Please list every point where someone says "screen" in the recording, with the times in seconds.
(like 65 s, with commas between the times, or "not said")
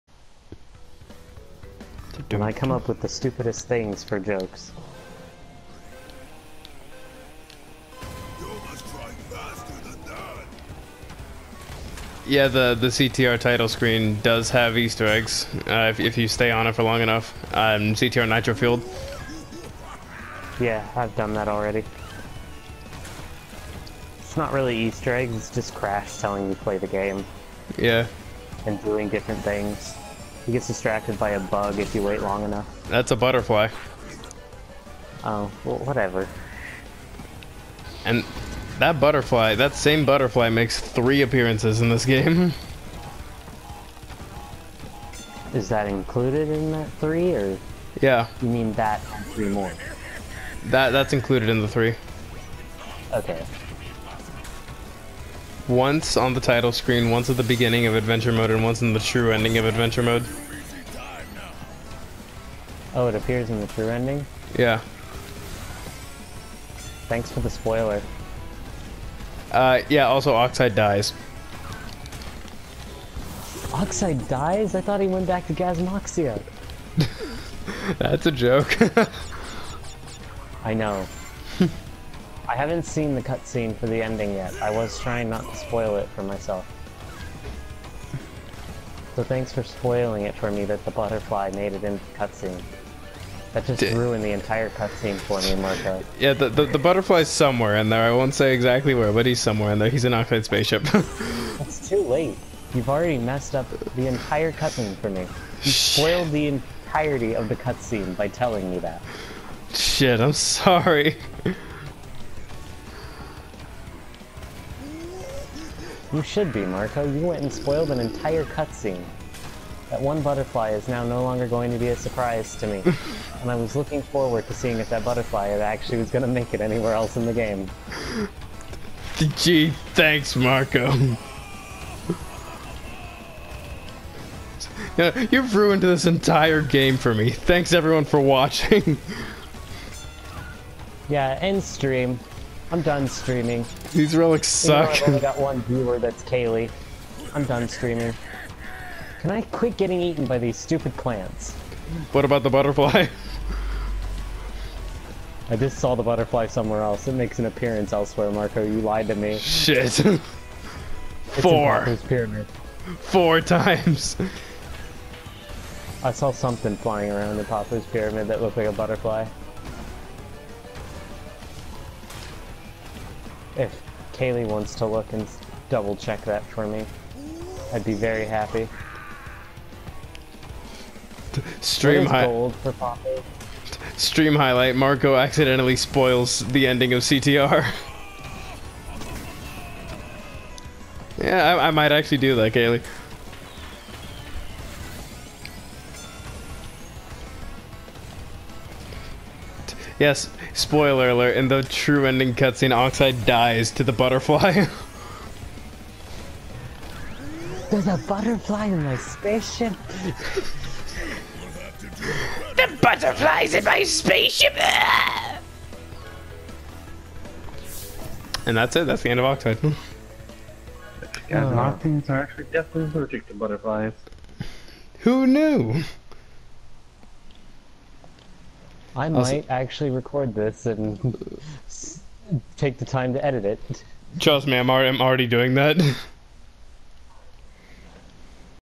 13 s, 56 s.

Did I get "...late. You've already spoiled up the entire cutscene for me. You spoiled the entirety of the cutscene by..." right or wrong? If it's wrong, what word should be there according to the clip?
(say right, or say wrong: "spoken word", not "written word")
wrong: "messed", not "spoiled".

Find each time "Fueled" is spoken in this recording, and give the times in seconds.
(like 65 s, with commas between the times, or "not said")
18 s.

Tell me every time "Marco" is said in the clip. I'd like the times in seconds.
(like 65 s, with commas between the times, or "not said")
95 s, 116 s, 130 s, 158 s, 184 s.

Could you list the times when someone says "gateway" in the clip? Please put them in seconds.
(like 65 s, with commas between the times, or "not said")
not said.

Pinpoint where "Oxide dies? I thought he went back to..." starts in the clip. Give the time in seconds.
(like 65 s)
73 s.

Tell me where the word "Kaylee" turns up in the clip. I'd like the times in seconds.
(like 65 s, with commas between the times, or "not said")
146 s, 174 s, 192 s.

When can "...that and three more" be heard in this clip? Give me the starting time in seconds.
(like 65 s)
48 s.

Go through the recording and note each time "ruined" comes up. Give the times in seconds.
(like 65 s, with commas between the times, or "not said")
93 s, 135 s.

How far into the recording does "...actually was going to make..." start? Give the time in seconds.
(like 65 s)
125 s.